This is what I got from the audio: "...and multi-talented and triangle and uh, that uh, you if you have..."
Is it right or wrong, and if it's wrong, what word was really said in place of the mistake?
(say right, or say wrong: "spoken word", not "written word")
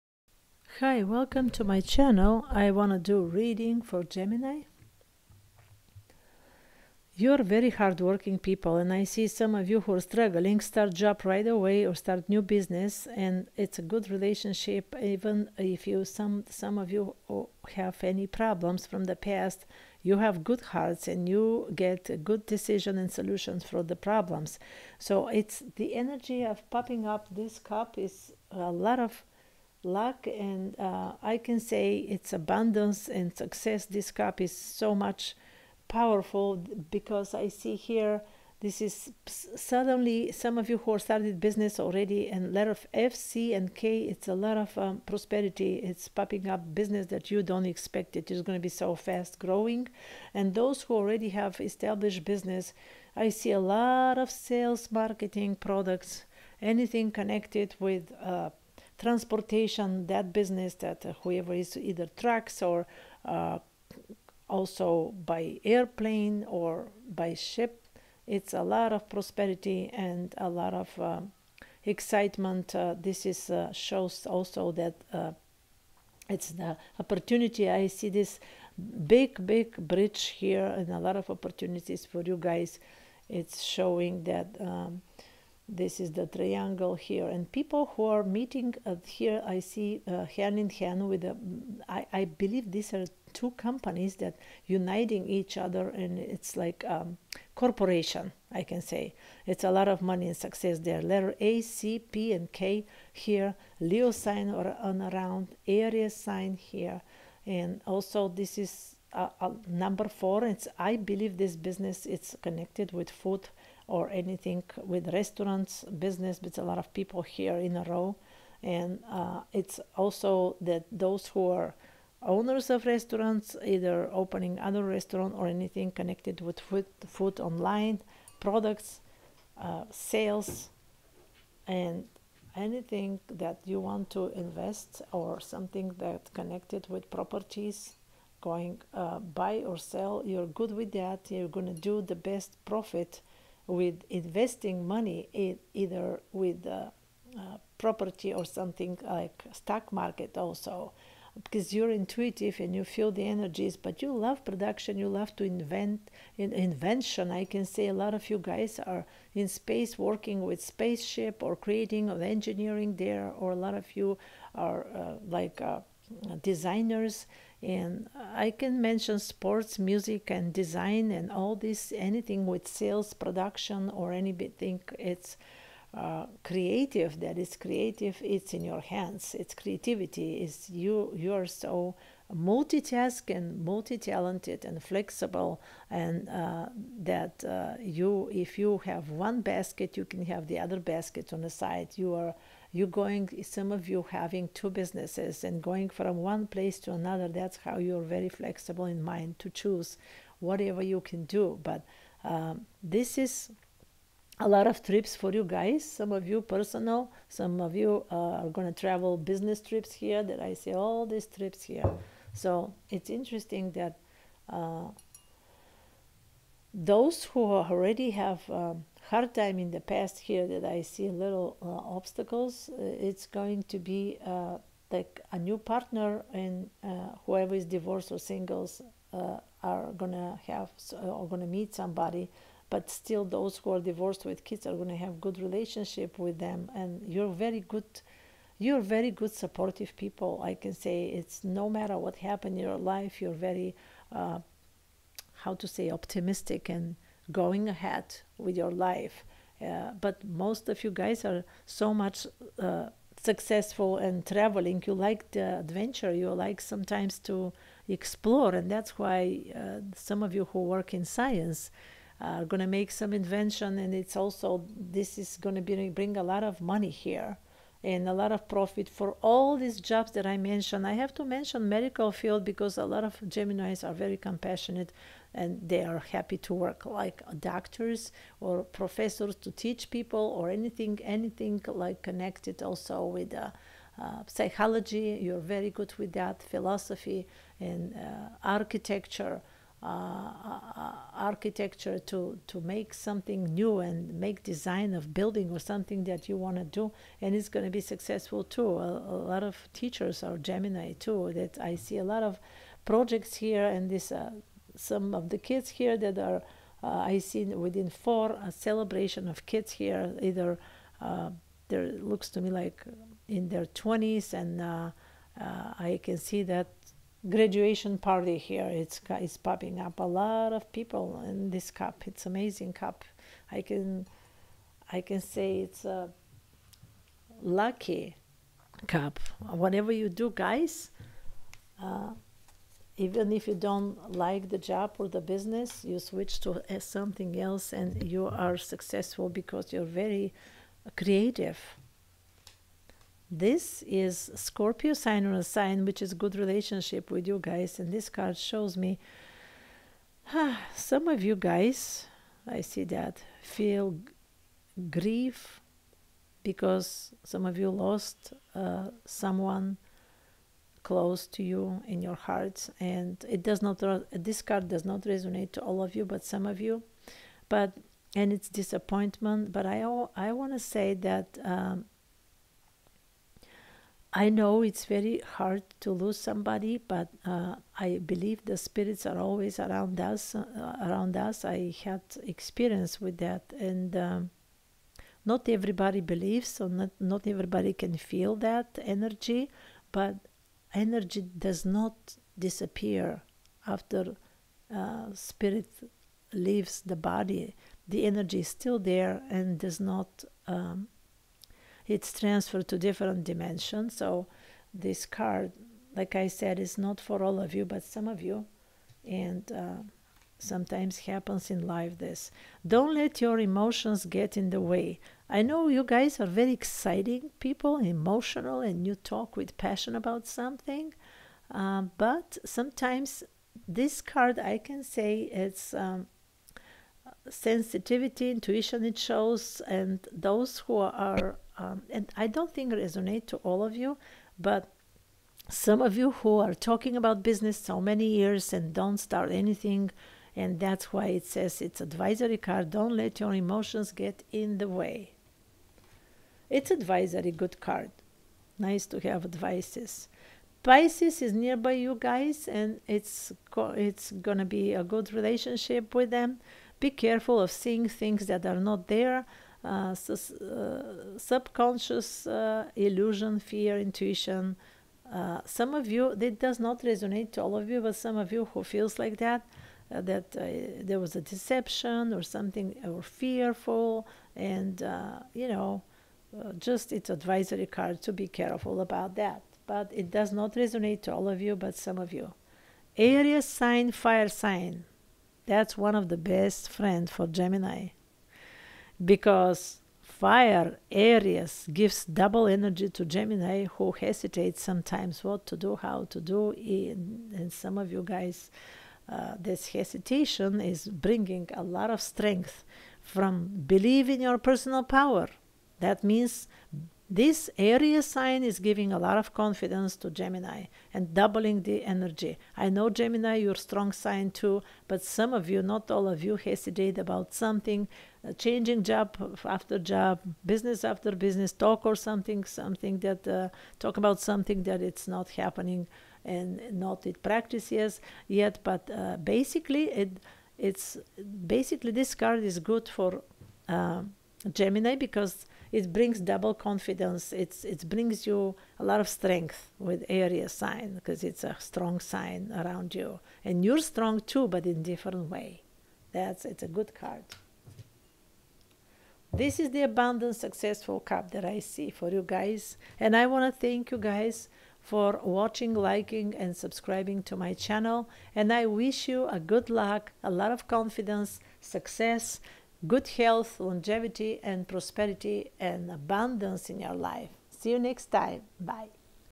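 wrong: "flexible", not "triangle".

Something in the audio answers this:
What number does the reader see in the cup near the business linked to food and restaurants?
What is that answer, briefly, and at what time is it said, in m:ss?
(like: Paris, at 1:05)
4, at 1:49.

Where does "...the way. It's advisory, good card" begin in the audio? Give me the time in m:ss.
7:24.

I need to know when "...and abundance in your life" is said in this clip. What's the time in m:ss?
9:25.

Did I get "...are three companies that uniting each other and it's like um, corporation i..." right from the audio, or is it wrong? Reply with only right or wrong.
wrong.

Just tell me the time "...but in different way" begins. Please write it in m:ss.
9:04.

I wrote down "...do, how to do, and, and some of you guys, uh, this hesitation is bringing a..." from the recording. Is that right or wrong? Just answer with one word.
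right.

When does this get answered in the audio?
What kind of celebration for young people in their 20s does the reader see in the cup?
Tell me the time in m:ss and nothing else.
5:17.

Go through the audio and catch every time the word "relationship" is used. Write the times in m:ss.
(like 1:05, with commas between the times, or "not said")
0:14, 3:55, 5:46, 7:35.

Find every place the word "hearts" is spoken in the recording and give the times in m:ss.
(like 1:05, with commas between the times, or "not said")
0:20, 6:02.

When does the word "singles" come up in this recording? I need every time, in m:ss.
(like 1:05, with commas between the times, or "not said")
3:48.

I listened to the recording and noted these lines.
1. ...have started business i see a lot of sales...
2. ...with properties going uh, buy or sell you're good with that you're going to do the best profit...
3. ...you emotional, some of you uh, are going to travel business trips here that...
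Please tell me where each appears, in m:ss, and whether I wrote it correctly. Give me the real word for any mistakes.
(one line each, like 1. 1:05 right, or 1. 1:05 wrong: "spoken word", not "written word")
1. 0:51 wrong: "established", not "started"
2. 2:16 right
3. 3:26 wrong: "personal", not "emotional".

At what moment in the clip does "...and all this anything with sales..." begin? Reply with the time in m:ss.
2:51.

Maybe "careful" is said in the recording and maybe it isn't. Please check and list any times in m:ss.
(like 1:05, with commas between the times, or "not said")
7:36, 7:58.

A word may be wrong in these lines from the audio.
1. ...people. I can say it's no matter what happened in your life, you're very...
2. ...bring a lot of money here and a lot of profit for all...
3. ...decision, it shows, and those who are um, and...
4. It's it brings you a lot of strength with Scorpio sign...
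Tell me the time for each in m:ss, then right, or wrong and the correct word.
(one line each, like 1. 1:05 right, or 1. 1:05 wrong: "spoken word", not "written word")
1. 3:59 right
2. 4:25 right
3. 7:08 wrong: "intuition", not "decision"
4. 8:57 wrong: "Aries", not "Scorpio".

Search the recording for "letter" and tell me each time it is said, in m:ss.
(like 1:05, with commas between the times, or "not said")
1:41.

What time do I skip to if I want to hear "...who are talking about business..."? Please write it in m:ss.
7:16.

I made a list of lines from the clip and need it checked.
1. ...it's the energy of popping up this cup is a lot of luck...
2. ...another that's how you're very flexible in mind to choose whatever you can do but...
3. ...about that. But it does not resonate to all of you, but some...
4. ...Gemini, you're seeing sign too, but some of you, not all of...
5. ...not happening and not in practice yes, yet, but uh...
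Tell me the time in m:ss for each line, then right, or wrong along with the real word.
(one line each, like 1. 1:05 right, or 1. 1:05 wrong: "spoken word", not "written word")
1. 0:25 right
2. 3:16 right
3. 7:58 right
4. 8:32 wrong: "strong", not "seeing"
5. 8:45 right.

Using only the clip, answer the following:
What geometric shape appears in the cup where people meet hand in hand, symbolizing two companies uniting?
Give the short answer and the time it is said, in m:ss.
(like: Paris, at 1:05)
Triangle, at 1:26.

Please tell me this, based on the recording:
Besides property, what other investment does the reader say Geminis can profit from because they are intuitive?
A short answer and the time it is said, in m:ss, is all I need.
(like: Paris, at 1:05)
Stock market, at 2:29.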